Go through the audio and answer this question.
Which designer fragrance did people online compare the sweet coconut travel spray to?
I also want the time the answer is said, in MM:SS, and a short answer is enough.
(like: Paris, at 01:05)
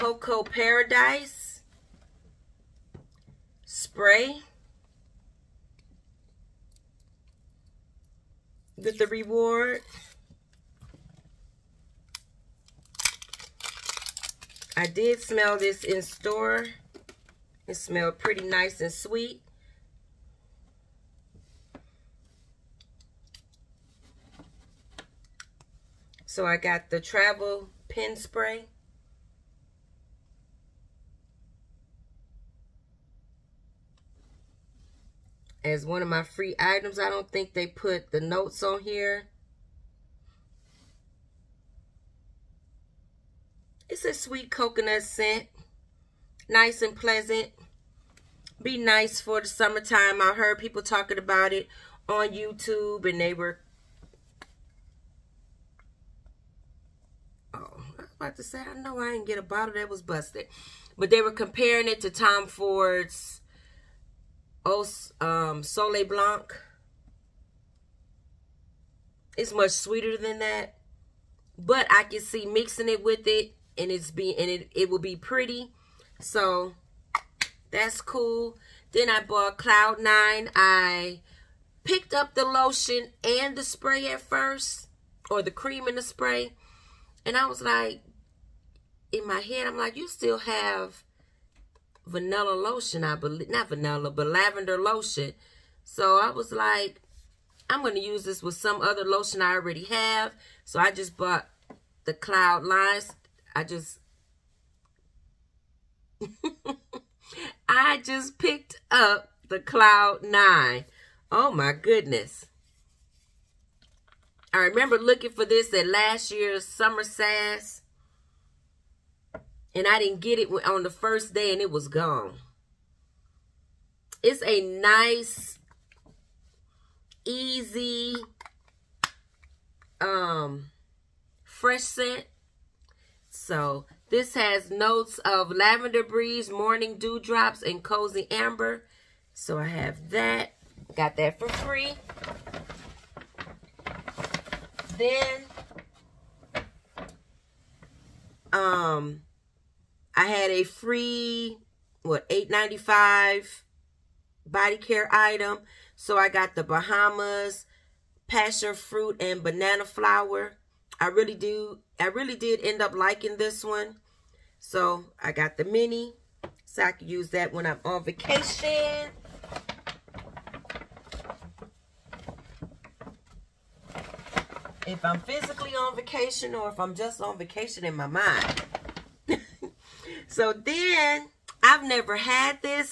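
Soleil Blanc, at 01:05.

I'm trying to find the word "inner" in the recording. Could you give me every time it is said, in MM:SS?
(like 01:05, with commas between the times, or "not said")
not said.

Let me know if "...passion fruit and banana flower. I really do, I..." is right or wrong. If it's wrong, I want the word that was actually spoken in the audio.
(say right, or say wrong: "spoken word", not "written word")
right.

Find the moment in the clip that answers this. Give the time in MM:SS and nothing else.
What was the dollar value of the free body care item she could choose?
02:32.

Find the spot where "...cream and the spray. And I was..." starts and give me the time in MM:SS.
01:25.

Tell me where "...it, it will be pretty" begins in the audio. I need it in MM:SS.
01:14.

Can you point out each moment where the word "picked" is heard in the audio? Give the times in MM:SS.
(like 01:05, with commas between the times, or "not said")
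01:21, 01:48.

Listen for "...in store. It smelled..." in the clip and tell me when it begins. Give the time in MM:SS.
00:15.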